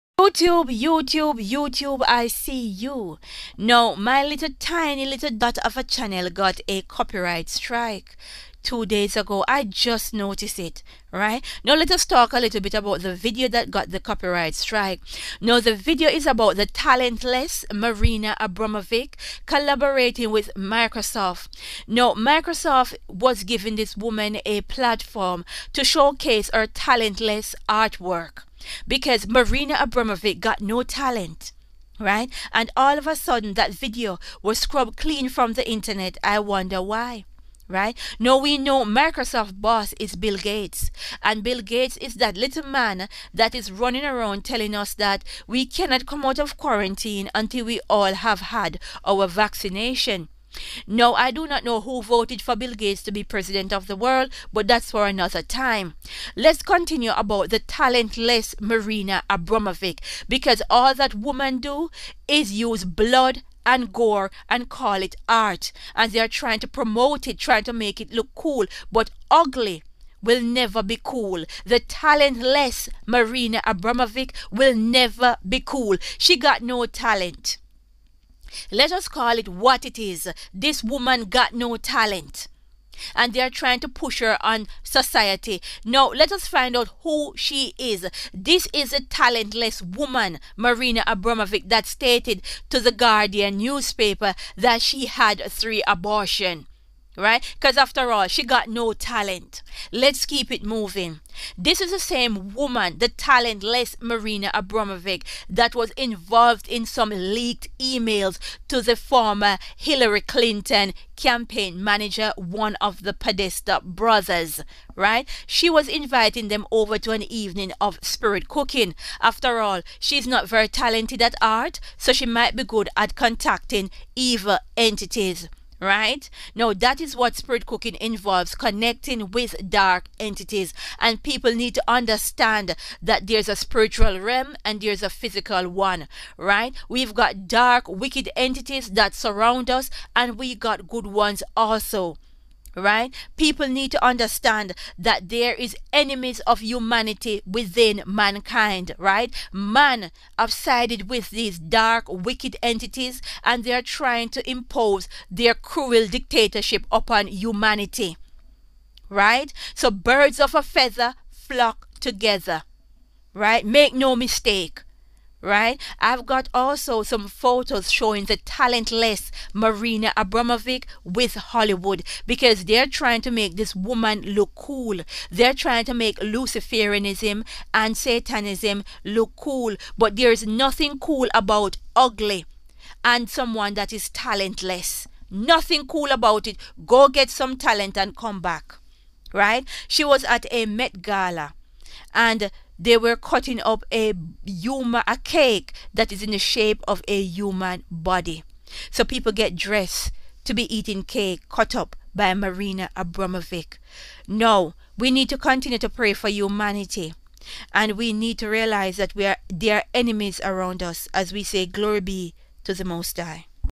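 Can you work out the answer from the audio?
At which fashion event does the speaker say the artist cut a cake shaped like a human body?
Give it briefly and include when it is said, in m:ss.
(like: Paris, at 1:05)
Met Gala, at 3:10.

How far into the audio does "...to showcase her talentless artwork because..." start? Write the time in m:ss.
0:25.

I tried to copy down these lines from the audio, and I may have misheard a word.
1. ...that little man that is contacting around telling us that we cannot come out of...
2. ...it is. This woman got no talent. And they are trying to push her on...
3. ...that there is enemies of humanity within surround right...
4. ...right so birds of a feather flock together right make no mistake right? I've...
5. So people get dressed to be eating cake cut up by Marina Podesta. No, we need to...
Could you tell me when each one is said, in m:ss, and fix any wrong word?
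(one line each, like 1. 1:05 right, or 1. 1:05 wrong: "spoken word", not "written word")
1. 0:42 wrong: "running", not "contacting"
2. 1:19 right
3. 2:24 wrong: "mankind", not "surround"
4. 2:39 right
5. 3:18 wrong: "Abramovic", not "Podesta".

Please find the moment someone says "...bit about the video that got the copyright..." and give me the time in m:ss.
0:12.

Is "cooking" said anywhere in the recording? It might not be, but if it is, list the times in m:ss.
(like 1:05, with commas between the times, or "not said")
1:58, 2:07.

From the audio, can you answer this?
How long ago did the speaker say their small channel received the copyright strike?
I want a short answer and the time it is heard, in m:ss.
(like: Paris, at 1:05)
2 days ago, at 0:08.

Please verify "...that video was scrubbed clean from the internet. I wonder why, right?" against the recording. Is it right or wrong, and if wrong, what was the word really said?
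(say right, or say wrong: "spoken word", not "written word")
right.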